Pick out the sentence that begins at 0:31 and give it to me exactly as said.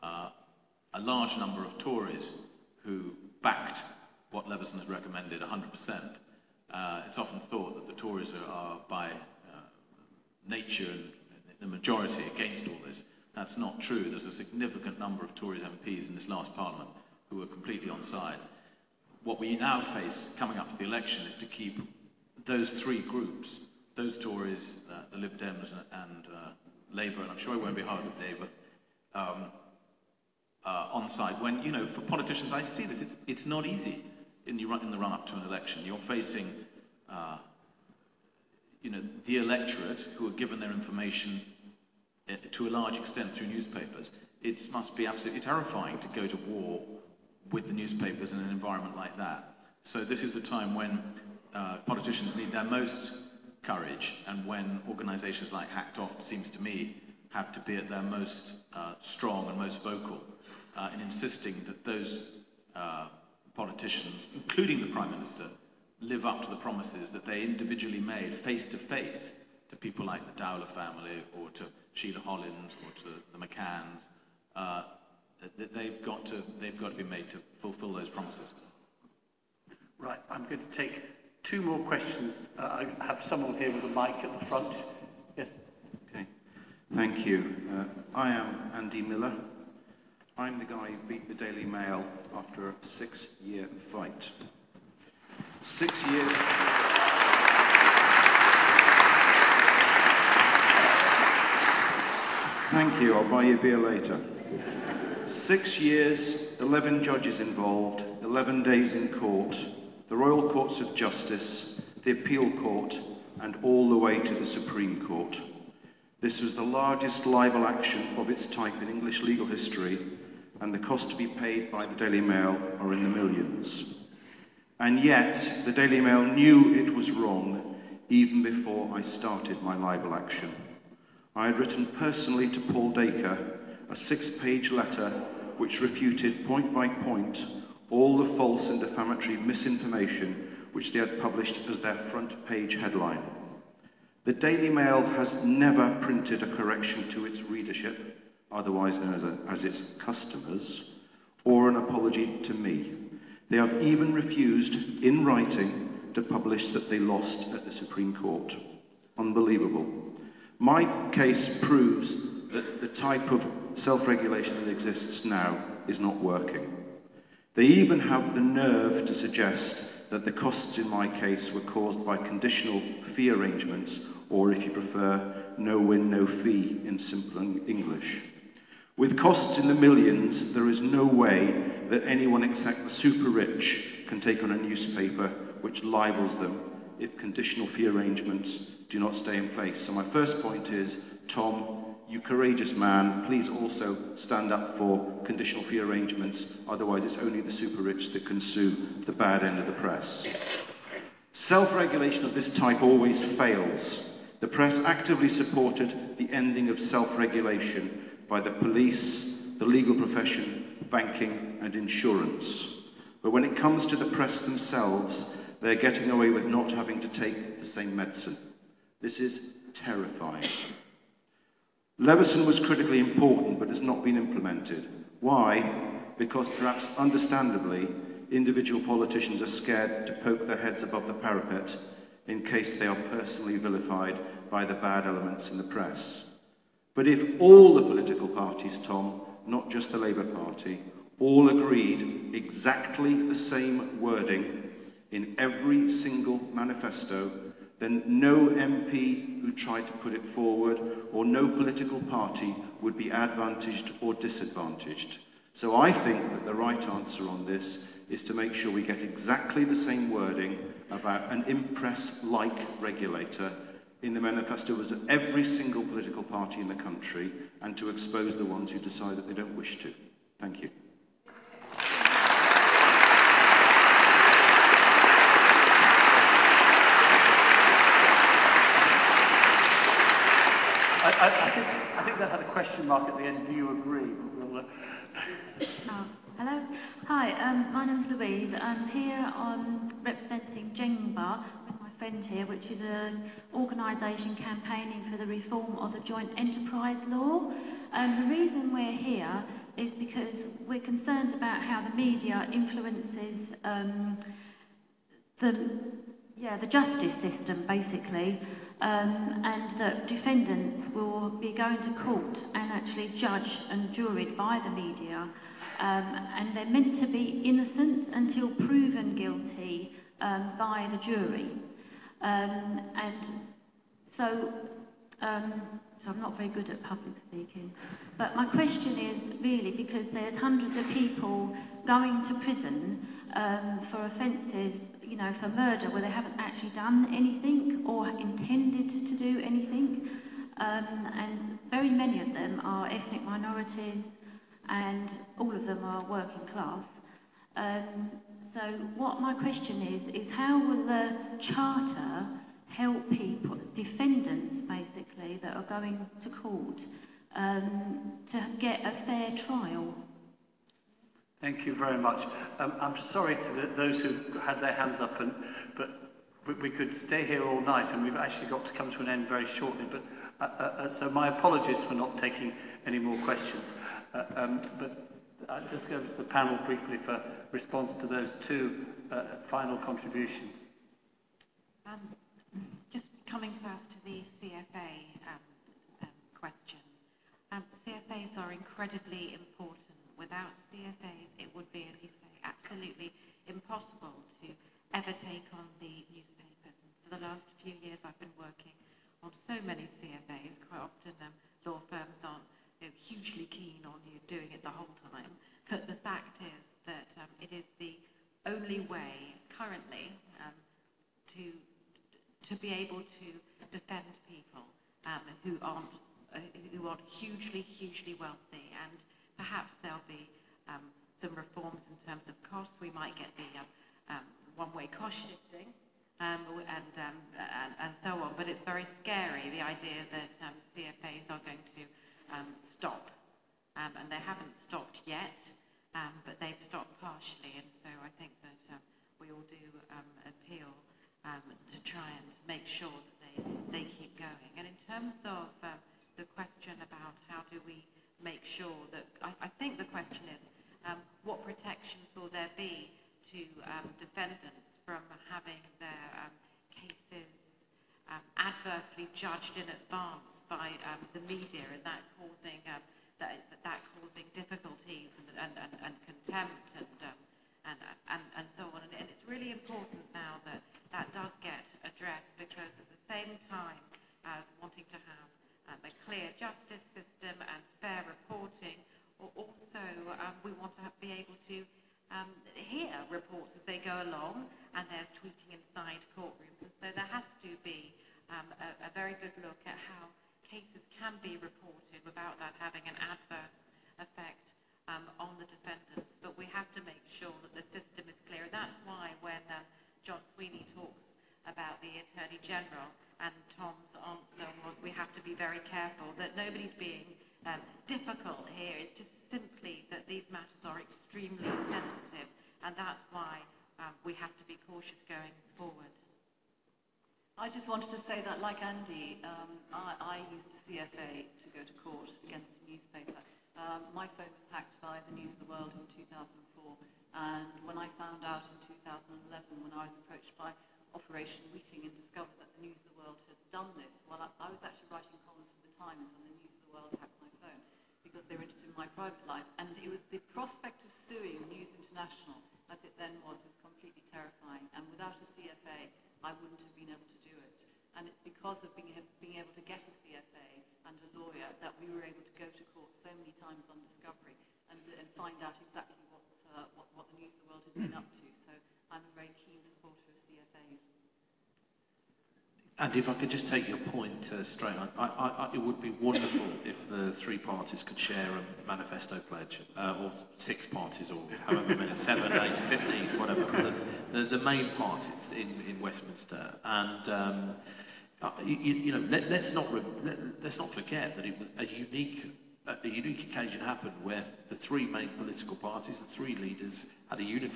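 When, you know, for politicians, I see this, it's, it's not easy in the, run, in the run-up to an election.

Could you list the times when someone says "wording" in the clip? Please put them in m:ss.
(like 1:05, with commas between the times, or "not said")
4:04, 4:20.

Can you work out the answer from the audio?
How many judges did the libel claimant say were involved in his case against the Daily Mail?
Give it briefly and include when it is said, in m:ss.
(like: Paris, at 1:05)
11, at 1:46.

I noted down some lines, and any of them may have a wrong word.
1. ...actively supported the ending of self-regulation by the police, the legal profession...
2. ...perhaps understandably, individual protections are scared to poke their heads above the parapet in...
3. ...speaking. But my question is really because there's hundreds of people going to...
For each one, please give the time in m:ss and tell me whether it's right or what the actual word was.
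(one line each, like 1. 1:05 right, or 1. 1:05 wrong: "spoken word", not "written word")
1. 3:24 right
2. 3:46 wrong: "politicians", not "protections"
3. 5:27 right.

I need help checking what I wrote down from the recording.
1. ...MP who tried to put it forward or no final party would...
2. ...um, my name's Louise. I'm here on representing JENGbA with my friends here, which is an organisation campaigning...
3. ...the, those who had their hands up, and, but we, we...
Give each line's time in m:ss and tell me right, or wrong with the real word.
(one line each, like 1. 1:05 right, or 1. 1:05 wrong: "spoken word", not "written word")
1. 4:08 wrong: "political", not "final"
2. 4:47 right
3. 6:03 right.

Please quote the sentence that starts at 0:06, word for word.
Uh, it's often thought that the Tories are, are by uh, nature and the majority against all this.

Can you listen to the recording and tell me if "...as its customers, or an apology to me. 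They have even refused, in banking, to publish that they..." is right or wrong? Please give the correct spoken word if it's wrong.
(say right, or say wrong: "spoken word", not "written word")
wrong: "writing", not "banking".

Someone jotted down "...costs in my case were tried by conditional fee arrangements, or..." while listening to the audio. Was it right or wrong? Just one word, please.
wrong.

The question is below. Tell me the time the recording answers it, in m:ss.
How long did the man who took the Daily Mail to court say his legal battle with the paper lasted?
1:32.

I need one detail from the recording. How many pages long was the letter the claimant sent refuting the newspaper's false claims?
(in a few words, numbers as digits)
6.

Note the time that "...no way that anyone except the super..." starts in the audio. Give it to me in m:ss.
3:00.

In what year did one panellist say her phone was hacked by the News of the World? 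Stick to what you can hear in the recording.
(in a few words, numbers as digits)
2004.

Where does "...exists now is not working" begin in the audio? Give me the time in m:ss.
2:44.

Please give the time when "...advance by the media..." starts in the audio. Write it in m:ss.
7:39.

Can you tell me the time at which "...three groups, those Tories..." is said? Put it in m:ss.
0:22.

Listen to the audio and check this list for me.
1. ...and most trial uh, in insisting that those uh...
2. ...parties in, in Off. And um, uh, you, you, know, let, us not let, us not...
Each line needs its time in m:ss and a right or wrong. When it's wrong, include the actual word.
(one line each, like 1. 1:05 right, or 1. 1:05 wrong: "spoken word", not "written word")
1. 0:59 wrong: "vocal", not "trial"
2. 9:34 wrong: "Westminster", not "Off".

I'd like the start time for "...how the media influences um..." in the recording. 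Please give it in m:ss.
5:01.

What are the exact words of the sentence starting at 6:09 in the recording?
But uh, uh, uh so my apologies for not taking any more questions.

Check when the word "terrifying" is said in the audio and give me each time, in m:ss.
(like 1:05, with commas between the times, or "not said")
0:45, 3:39.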